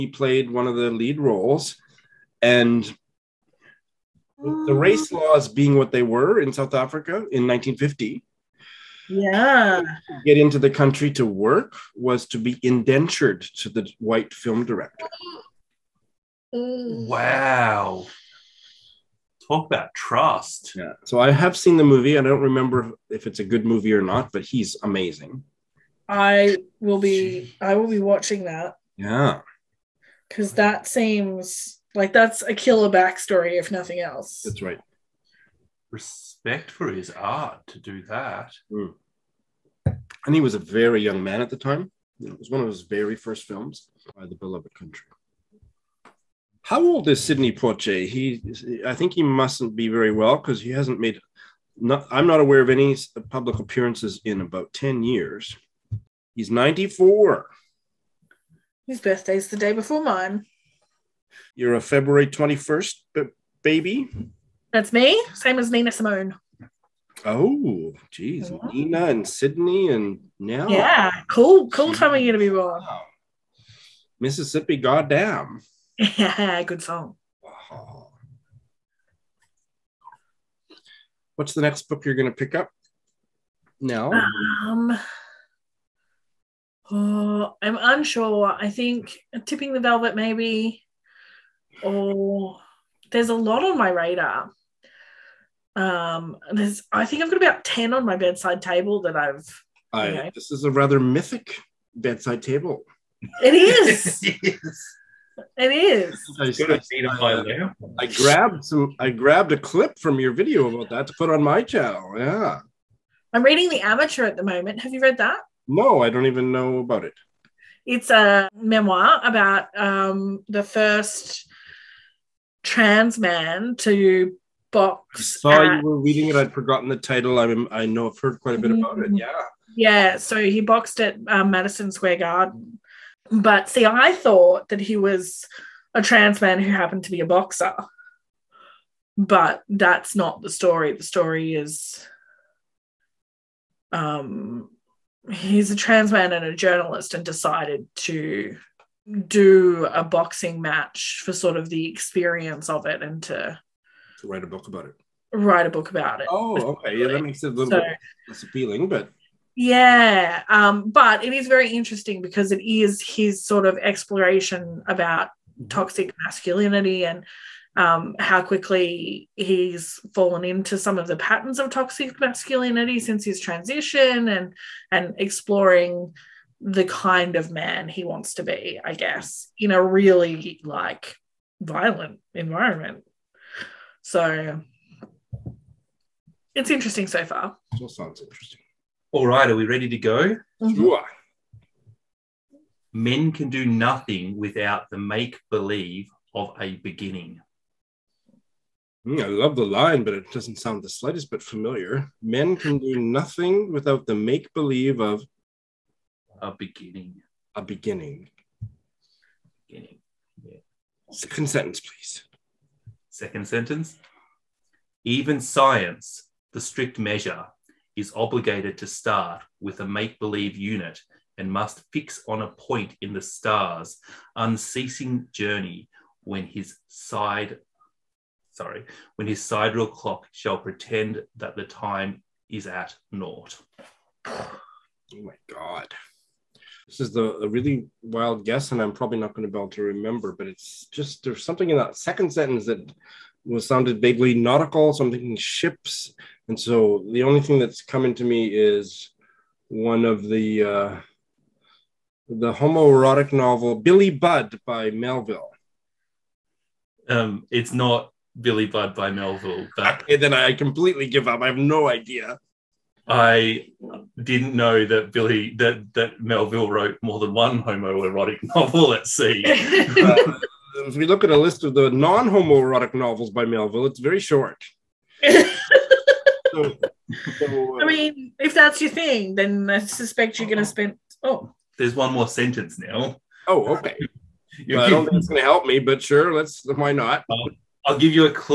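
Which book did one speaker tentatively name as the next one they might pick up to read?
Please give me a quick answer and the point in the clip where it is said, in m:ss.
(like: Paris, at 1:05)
Tipping the Velvet, at 1:29.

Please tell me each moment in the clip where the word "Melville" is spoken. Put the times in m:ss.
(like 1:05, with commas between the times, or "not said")
4:14, 4:19, 4:26, 4:33.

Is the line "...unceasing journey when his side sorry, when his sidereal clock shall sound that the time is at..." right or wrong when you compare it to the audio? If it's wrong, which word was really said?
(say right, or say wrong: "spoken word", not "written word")
wrong: "pretend", not "sound".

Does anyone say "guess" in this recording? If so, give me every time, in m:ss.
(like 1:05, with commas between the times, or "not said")
2:58, 3:58.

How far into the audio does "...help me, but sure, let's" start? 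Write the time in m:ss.
4:45.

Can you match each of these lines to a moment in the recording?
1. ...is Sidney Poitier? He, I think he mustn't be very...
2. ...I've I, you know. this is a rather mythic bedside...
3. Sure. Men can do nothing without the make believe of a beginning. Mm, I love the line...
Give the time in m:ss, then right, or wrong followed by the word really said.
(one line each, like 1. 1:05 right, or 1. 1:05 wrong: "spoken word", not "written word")
1. 0:47 right
2. 1:39 right
3. 3:10 right.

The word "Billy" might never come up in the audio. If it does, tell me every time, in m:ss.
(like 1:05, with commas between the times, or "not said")
4:13, 4:18, 4:25.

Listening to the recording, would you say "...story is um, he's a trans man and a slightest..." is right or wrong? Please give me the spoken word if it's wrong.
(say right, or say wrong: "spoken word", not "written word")
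wrong: "journalist", not "slightest".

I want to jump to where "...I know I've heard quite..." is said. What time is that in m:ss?
2:07.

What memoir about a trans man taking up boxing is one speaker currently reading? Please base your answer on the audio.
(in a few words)
The Amateur.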